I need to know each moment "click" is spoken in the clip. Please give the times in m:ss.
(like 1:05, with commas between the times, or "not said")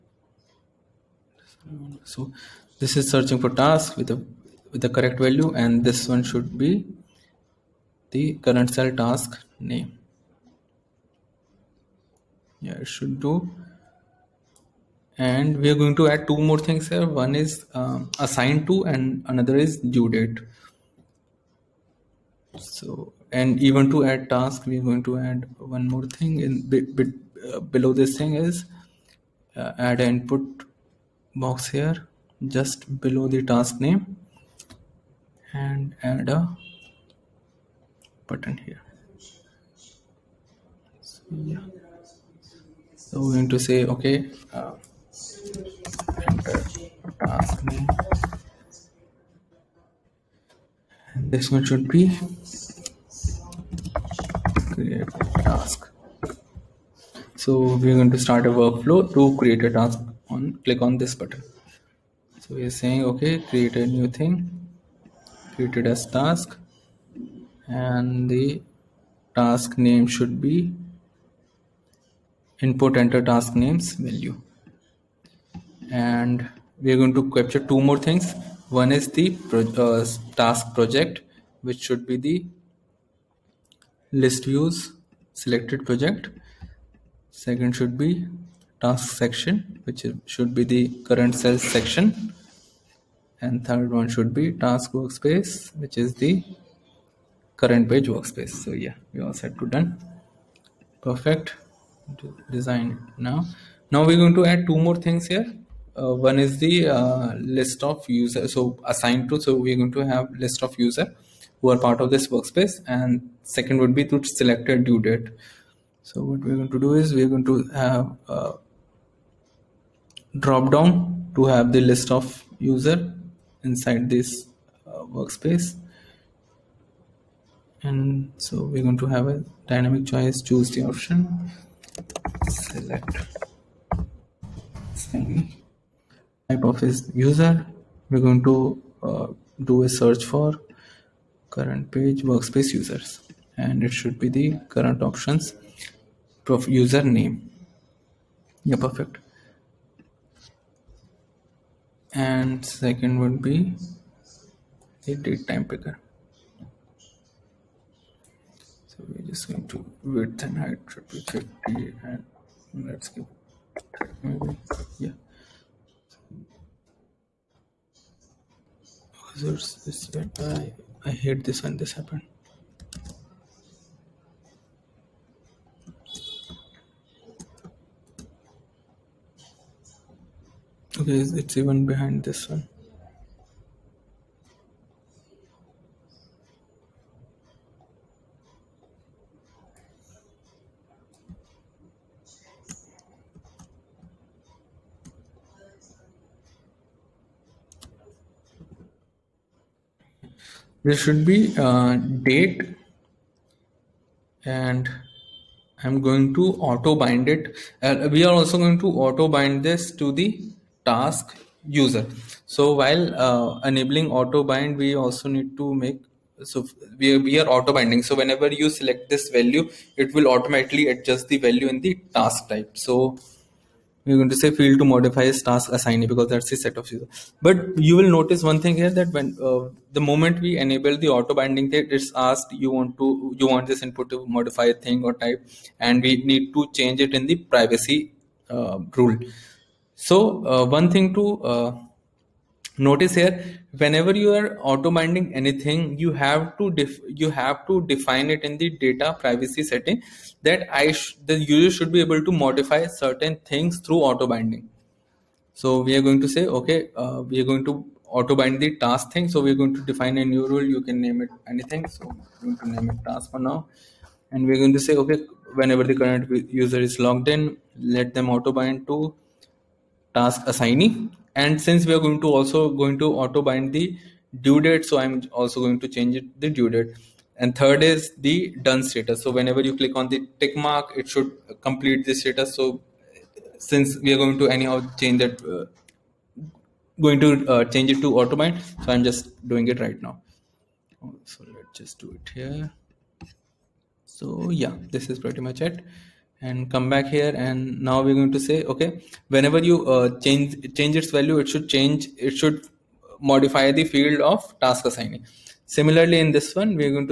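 1:00, 4:39.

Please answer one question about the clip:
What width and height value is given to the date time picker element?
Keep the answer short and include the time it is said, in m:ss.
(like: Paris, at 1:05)
50, at 2:41.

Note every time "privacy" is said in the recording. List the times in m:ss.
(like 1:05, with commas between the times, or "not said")
3:57, 4:09.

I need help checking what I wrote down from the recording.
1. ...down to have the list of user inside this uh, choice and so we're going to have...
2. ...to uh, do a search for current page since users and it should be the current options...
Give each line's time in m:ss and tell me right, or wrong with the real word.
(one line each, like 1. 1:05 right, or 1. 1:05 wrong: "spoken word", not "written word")
1. 2:00 wrong: "workspace", not "choice"
2. 2:18 wrong: "workspace", not "since".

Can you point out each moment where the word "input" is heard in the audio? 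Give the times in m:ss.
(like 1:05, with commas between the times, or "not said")
0:29, 1:12, 3:53.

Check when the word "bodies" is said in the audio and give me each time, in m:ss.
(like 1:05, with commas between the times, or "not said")
not said.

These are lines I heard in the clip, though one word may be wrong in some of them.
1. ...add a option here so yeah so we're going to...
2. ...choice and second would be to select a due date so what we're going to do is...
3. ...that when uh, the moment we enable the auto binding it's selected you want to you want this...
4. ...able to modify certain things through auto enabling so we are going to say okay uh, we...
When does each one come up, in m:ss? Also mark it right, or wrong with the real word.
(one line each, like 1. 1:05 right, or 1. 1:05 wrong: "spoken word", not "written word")
1. 0:36 wrong: "button", not "option"
2. 1:52 wrong: "workspace", not "choice"
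3. 3:48 wrong: "asked", not "selected"
4. 4:11 wrong: "binding", not "enabling".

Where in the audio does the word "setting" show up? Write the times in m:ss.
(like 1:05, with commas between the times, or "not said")
4:09.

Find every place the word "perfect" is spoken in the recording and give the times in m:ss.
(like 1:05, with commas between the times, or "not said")
1:41, 2:28.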